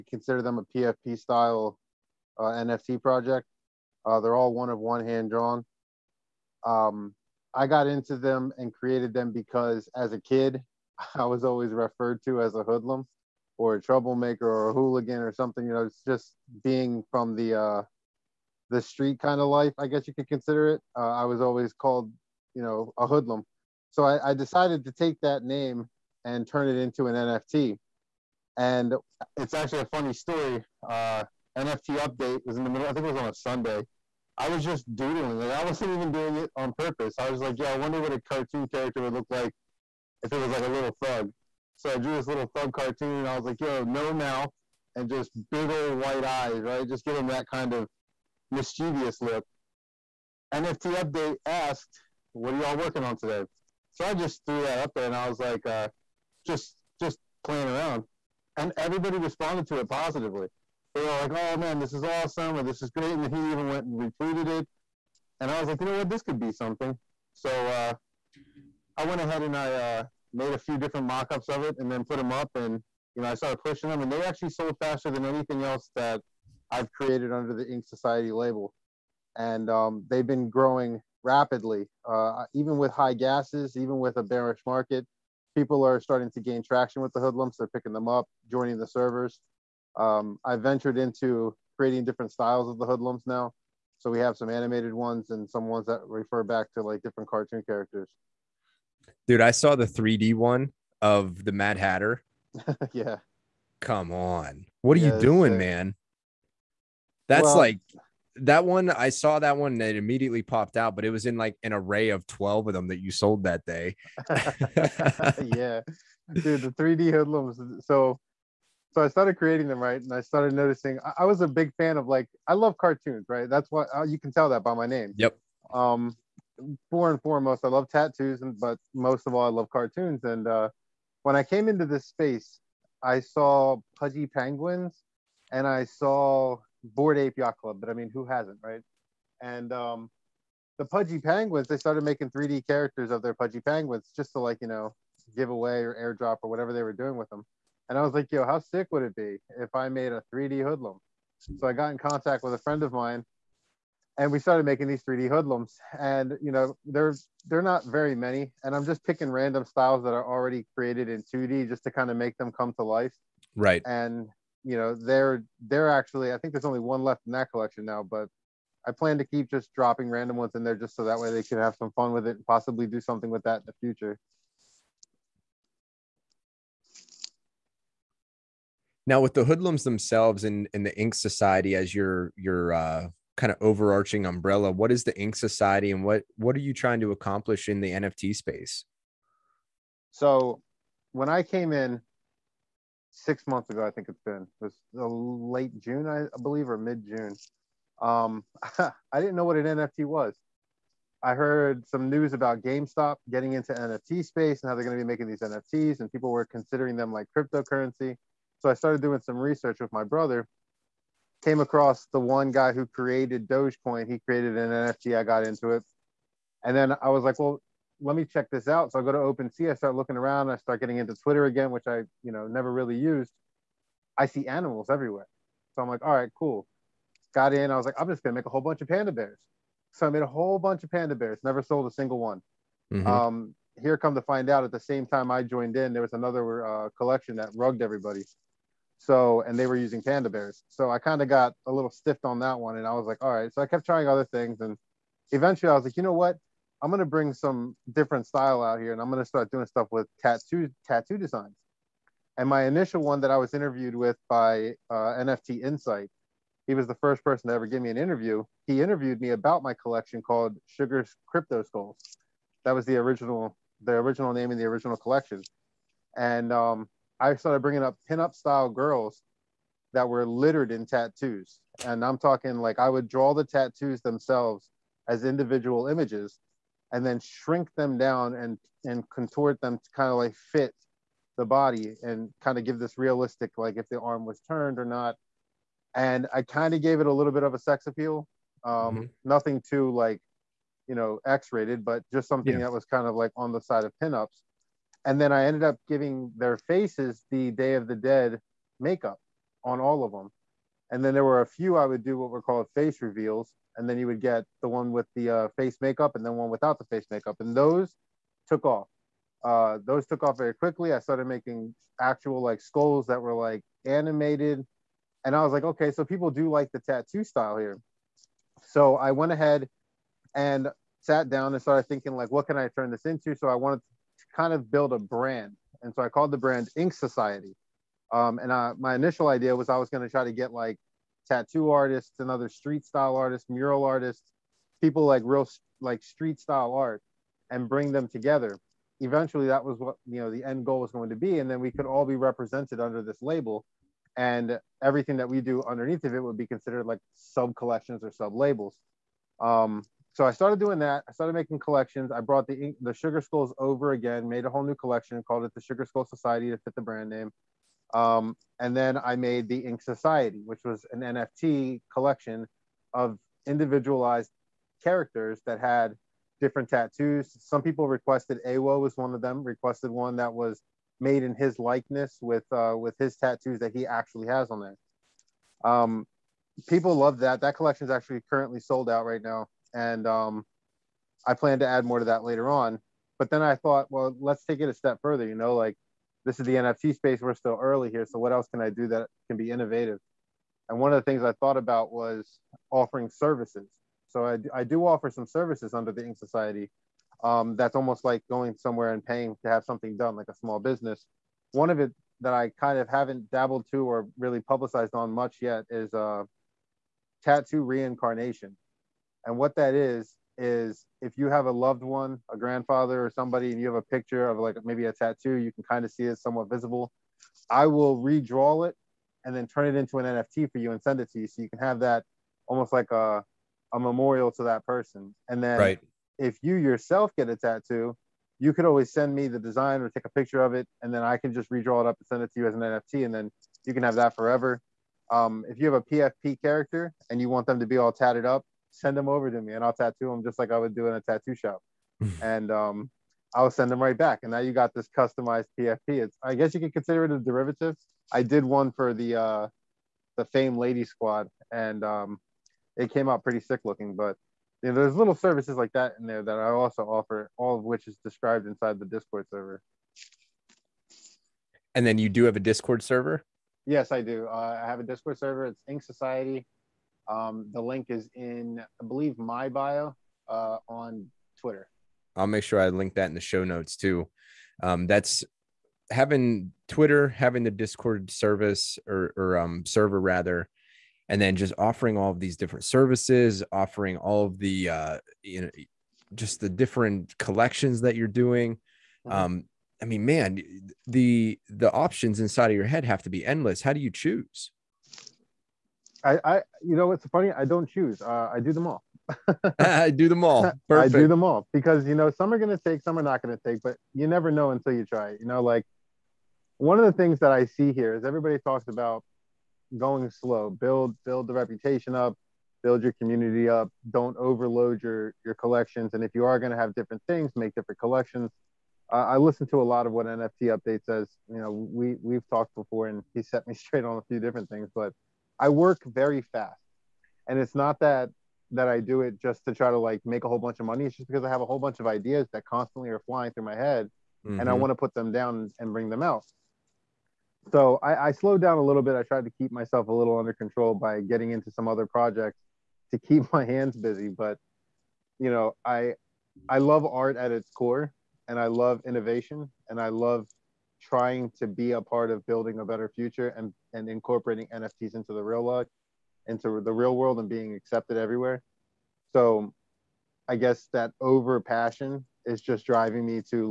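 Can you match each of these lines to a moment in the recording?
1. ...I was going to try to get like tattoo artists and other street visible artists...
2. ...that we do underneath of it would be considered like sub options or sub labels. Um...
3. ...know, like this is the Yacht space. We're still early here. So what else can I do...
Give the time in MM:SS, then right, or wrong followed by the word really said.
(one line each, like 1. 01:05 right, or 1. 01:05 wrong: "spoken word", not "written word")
1. 05:29 wrong: "style", not "visible"
2. 05:45 wrong: "collections", not "options"
3. 06:25 wrong: "NFT", not "Yacht".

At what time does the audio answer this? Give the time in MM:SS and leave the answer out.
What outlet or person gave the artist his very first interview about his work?
04:15.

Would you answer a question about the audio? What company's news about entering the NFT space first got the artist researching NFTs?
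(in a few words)
GameStop.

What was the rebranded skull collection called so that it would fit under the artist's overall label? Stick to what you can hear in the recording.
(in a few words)
Sugar Skull Society.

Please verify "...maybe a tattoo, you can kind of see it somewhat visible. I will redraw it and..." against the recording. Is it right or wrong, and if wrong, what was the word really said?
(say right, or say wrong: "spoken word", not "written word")
right.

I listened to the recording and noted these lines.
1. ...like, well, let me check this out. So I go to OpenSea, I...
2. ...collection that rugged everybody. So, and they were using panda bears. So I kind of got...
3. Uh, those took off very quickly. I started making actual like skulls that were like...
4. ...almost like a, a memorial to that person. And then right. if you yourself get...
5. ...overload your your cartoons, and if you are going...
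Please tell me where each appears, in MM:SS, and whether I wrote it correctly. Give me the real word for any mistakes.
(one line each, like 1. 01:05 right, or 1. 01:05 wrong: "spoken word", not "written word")
1. 03:37 right
2. 03:56 right
3. 05:09 right
4. 07:02 right
5. 08:34 wrong: "collections", not "cartoons".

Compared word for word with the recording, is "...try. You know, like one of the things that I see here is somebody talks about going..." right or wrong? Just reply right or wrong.
wrong.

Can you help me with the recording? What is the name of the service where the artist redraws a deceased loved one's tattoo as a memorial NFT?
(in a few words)
Tattoo reincarnation.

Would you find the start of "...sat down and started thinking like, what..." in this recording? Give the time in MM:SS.
05:21.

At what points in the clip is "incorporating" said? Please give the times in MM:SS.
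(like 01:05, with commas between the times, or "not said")
09:13.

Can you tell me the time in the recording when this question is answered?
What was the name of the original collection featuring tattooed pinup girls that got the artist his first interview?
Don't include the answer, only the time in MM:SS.
04:20.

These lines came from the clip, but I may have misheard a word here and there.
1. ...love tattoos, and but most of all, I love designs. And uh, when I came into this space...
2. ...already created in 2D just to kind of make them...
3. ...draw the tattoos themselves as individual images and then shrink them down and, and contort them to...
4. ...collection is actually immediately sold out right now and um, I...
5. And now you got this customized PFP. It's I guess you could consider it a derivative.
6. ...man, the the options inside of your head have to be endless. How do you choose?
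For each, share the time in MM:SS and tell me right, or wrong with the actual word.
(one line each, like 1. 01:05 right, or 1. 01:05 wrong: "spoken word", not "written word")
1. 02:07 wrong: "cartoons", not "designs"
2. 02:40 right
3. 04:33 right
4. 06:17 wrong: "currently", not "immediately"
5. 07:24 right
6. 08:10 right.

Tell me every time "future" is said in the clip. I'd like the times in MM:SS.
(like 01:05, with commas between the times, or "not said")
02:53, 09:12.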